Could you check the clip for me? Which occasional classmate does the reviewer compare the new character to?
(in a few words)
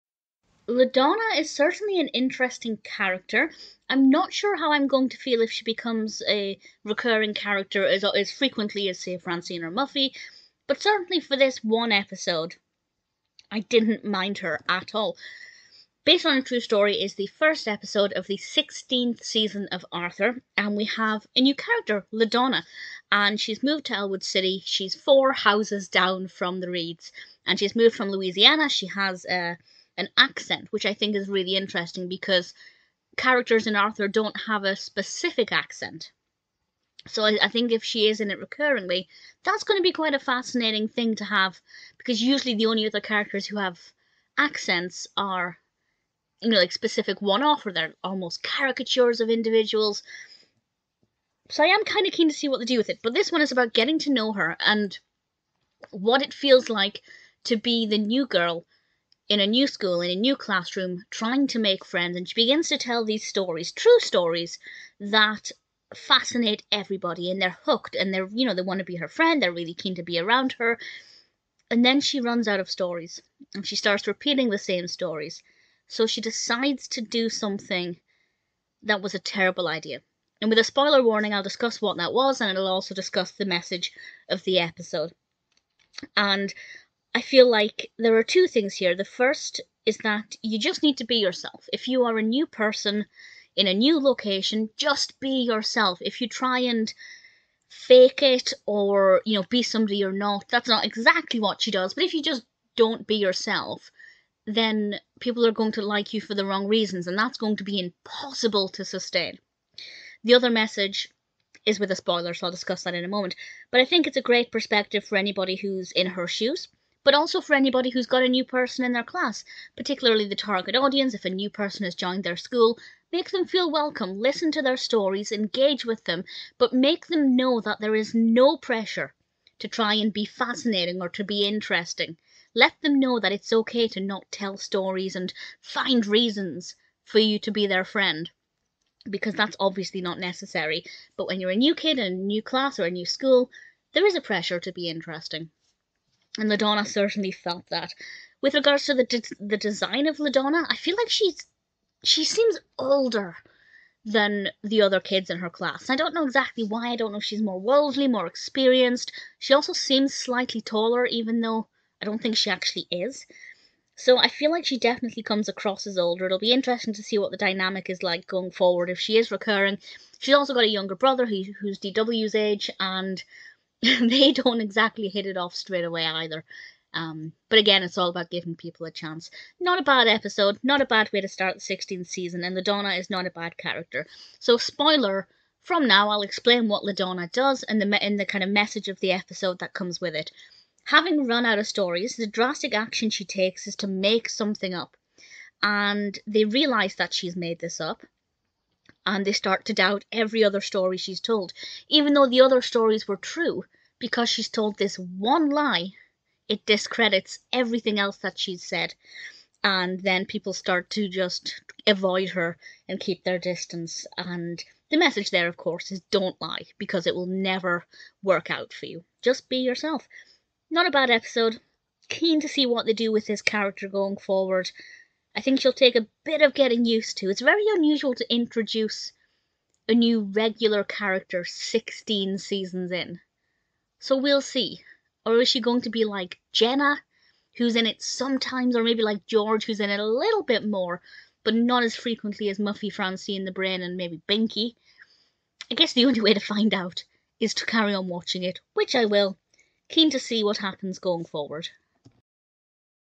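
Jenna.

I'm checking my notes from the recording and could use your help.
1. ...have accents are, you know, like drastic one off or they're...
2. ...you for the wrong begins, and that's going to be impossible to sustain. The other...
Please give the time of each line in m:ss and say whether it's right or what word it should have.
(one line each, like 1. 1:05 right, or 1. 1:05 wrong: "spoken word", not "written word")
1. 0:43 wrong: "specific", not "drastic"
2. 1:46 wrong: "reasons", not "begins".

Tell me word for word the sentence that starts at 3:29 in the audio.
And then people start to just avoid her and keep their distance.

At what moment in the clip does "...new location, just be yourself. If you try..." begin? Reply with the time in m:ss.
1:33.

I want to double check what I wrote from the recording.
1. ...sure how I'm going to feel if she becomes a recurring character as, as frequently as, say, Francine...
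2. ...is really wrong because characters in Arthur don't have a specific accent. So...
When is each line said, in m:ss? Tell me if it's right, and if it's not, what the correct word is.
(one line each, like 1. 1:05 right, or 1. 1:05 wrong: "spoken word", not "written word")
1. 0:04 right
2. 0:31 wrong: "interesting", not "wrong".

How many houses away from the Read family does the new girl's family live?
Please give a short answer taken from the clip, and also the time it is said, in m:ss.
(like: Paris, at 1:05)
4, at 0:24.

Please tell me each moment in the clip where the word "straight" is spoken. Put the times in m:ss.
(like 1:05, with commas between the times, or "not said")
2:55.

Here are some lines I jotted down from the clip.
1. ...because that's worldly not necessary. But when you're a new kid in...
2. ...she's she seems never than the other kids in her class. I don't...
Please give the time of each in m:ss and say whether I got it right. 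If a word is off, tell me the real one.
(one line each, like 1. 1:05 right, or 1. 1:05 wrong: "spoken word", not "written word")
1. 2:19 wrong: "obviously", not "worldly"
2. 2:31 wrong: "older", not "never".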